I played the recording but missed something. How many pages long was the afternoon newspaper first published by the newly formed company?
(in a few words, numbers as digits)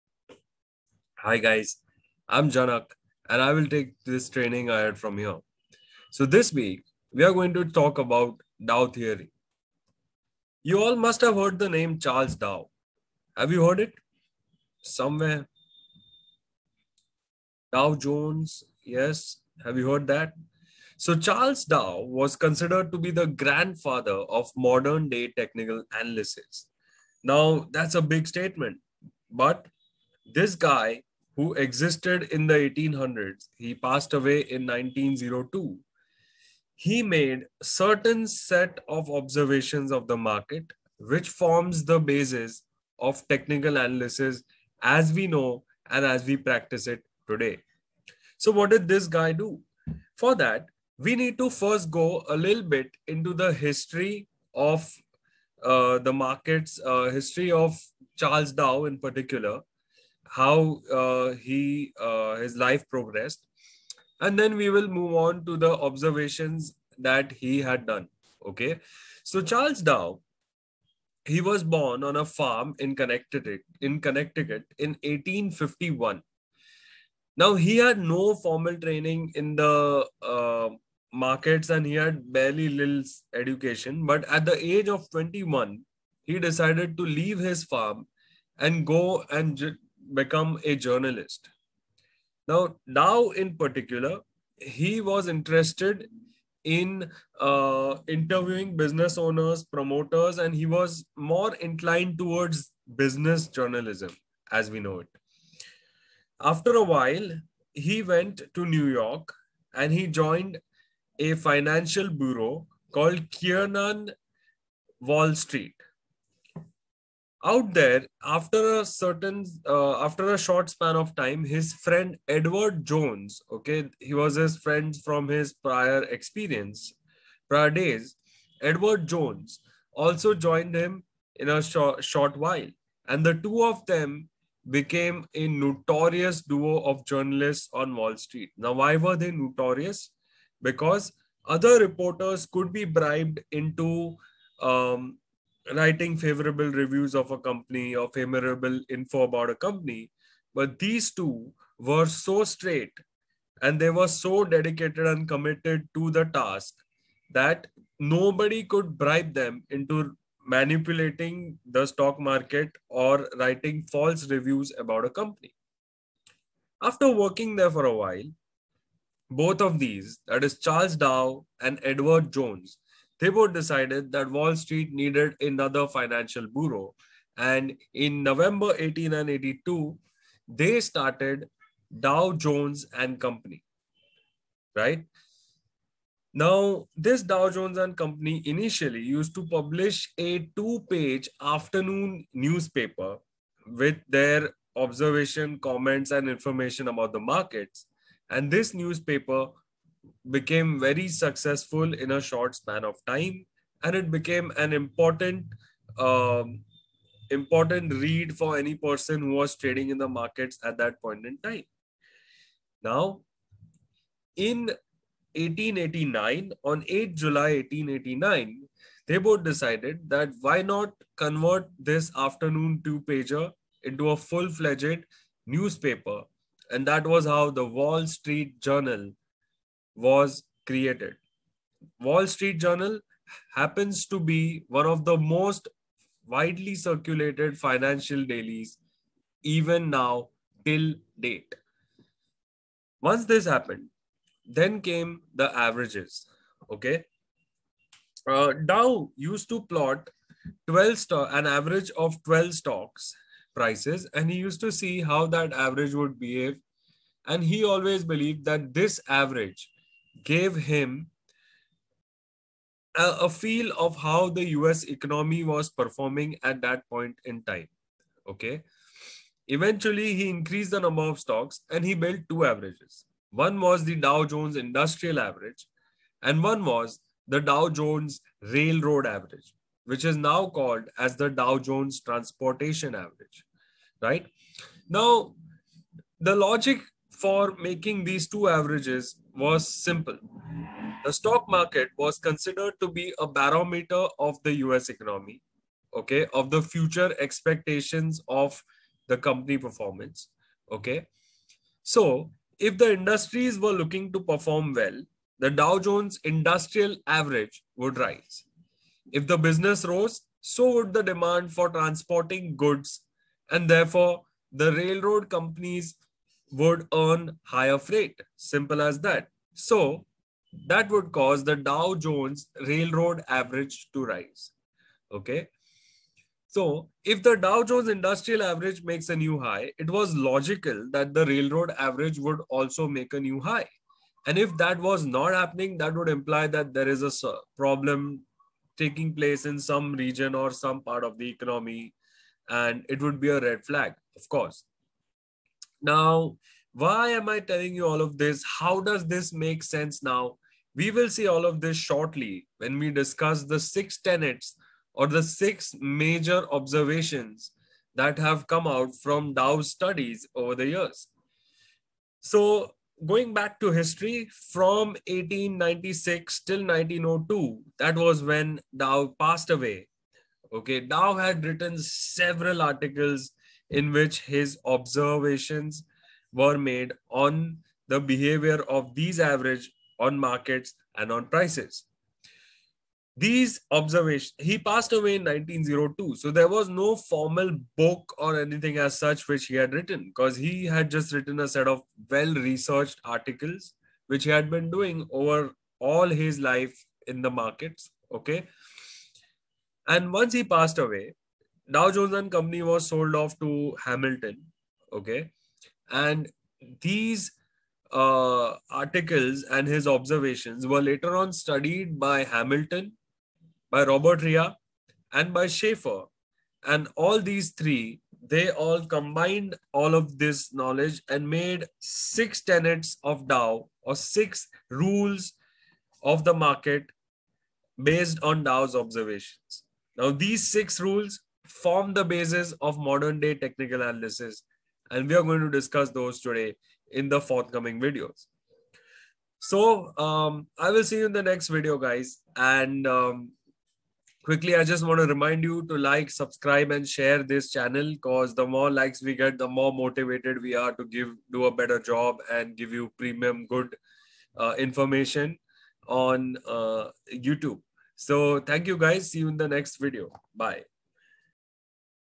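2.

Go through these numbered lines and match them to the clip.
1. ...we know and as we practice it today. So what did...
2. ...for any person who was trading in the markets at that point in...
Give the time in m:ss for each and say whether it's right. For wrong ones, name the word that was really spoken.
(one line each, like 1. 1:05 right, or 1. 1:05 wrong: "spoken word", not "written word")
1. 0:45 right
2. 3:28 right.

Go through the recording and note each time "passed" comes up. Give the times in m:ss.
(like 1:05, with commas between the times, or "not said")
0:33, 6:09, 6:24, 6:40.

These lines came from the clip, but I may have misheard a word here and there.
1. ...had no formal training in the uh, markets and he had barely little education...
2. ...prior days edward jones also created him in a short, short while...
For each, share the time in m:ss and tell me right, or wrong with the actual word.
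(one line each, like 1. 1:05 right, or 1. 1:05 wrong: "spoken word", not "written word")
1. 1:17 right
2. 2:07 wrong: "joined", not "created".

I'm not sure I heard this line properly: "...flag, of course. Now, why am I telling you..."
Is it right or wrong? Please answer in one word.
right.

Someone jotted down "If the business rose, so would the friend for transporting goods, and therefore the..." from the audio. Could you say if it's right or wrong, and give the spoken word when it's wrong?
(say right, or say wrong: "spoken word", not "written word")
wrong: "demand", not "friend".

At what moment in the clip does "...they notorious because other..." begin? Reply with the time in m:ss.
2:19.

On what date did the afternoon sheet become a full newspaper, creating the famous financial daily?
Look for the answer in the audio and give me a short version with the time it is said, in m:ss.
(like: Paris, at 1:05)
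8 July 1889, at 3:36.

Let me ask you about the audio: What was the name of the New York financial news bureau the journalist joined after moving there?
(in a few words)
Kiernan Wall Street.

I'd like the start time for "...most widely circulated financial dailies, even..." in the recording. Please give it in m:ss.
3:55.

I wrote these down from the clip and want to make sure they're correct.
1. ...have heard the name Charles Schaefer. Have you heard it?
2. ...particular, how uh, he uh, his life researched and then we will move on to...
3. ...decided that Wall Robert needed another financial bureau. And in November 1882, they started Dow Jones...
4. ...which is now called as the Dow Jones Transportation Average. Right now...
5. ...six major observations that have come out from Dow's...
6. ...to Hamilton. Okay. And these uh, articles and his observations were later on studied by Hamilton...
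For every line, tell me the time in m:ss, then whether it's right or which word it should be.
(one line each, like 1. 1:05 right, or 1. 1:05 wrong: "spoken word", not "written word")
1. 0:11 wrong: "Dow", not "Schaefer"
2. 0:58 wrong: "progressed", not "researched"
3. 2:53 wrong: "Street", not "Robert"
4. 4:39 right
5. 5:55 right
6. 6:43 right.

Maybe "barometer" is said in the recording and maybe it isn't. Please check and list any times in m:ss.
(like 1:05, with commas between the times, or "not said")
4:53.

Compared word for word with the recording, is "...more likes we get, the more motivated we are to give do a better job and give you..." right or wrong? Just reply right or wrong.
right.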